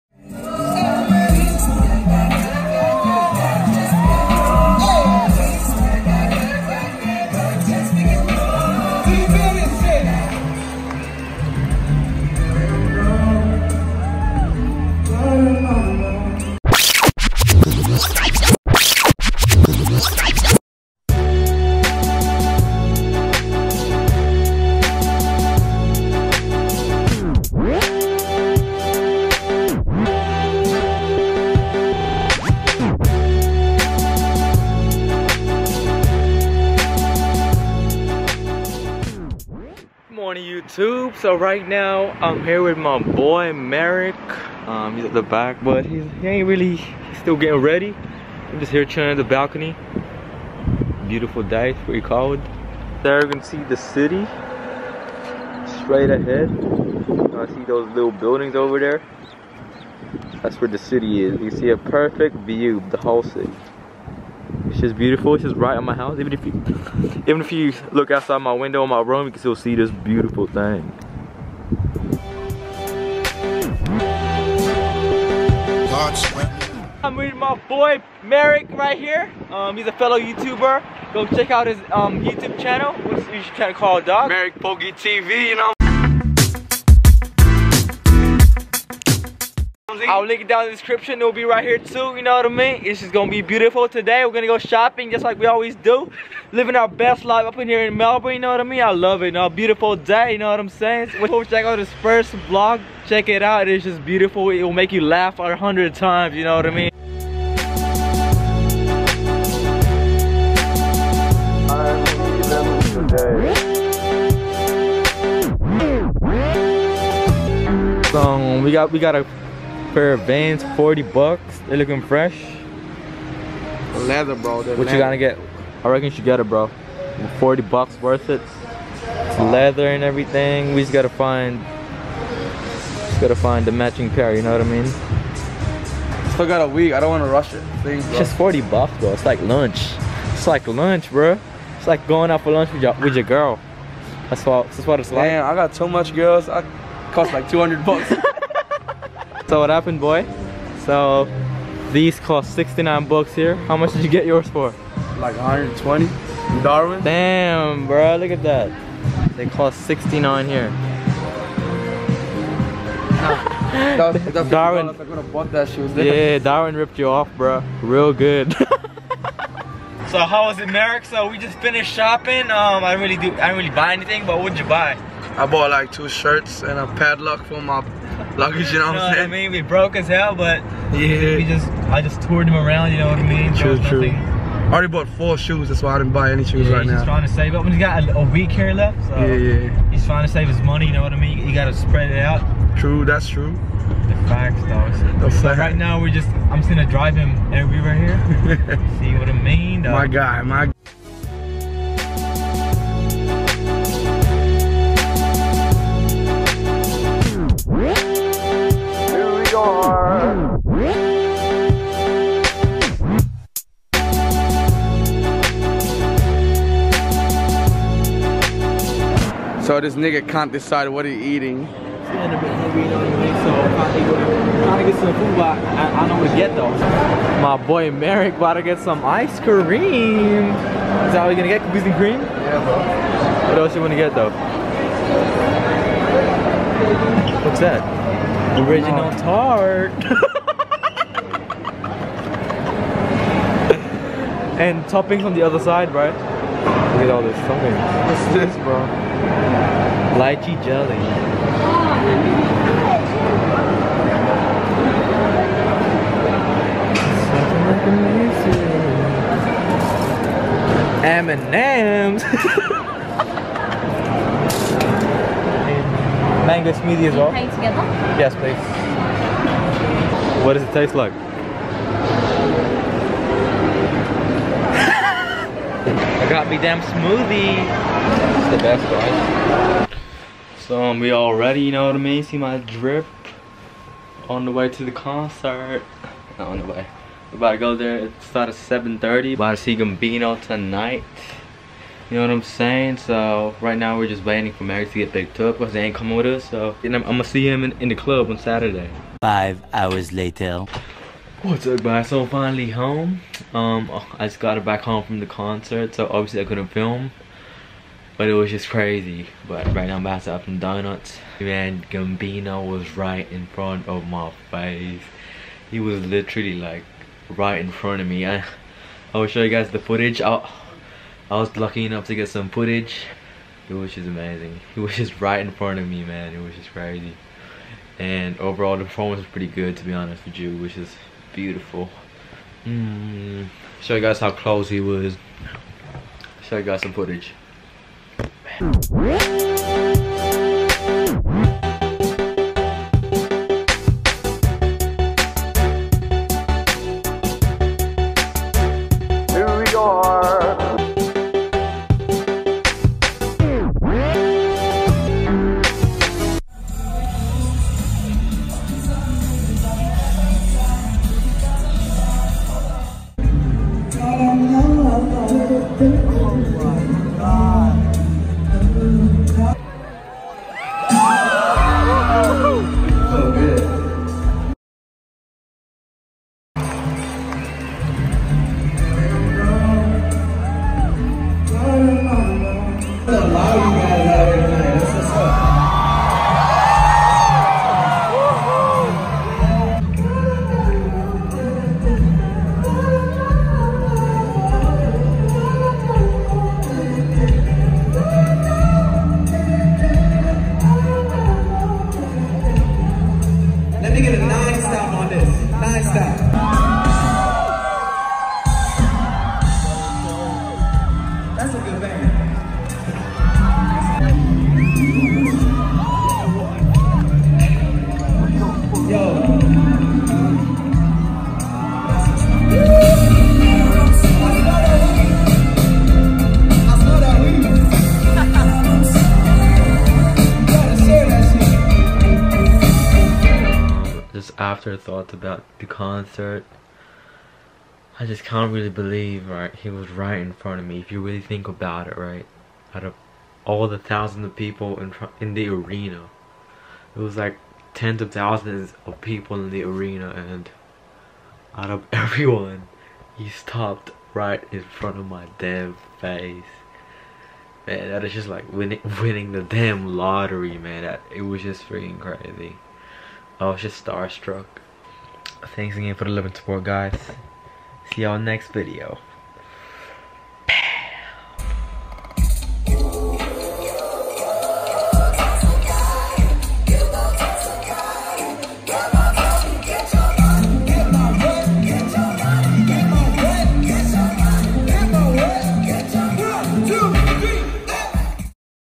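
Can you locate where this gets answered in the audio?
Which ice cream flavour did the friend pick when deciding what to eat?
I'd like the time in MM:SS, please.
03:51.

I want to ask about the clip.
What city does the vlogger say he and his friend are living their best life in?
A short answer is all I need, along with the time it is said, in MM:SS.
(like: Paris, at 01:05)
Melbourne, at 01:37.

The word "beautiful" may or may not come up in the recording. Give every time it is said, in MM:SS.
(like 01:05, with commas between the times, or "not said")
00:51, 01:04, 01:09, 01:33, 01:39, 01:44, 05:31.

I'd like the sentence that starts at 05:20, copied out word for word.
I'll, I was lucky enough to get some footage.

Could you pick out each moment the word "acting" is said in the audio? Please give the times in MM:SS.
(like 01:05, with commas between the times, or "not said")
not said.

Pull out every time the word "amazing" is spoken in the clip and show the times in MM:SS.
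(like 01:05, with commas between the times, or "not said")
04:21, 05:24.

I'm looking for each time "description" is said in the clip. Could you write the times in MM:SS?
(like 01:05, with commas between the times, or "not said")
01:30.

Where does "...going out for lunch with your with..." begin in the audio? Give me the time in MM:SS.
02:22.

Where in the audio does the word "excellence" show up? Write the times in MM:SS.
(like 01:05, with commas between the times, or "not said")
not said.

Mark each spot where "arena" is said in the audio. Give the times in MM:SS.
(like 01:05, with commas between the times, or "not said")
07:25, 07:29.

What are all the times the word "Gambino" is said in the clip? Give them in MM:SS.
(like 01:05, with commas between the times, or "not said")
04:49, 05:11.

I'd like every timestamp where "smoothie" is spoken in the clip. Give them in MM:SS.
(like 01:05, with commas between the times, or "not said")
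04:26, 04:36.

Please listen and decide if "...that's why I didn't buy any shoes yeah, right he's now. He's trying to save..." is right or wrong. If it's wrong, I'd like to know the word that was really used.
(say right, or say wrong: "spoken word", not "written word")
right.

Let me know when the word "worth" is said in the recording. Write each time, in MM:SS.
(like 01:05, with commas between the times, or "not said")
02:08.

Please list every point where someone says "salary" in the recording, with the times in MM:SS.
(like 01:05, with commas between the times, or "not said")
not said.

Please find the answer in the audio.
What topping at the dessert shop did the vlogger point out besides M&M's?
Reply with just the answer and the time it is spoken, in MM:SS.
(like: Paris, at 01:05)
Lychee jelly, at 04:10.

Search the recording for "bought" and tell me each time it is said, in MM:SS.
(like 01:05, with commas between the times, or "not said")
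02:55, 03:04.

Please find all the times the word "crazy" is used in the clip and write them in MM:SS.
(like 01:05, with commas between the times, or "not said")
05:08, 05:26, 07:41.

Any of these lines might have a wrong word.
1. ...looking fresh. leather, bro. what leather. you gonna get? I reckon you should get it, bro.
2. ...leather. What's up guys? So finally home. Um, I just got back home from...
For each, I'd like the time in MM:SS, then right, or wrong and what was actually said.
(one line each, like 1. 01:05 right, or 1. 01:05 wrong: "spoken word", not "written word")
1. 02:01 right
2. 05:00 wrong: "later", not "leather".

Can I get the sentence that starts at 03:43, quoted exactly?
So I'm trying to, get some food, but I, I, not know what to get though.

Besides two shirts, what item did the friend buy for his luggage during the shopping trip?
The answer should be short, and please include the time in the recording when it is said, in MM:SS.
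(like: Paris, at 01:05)
A padlock, at 02:56.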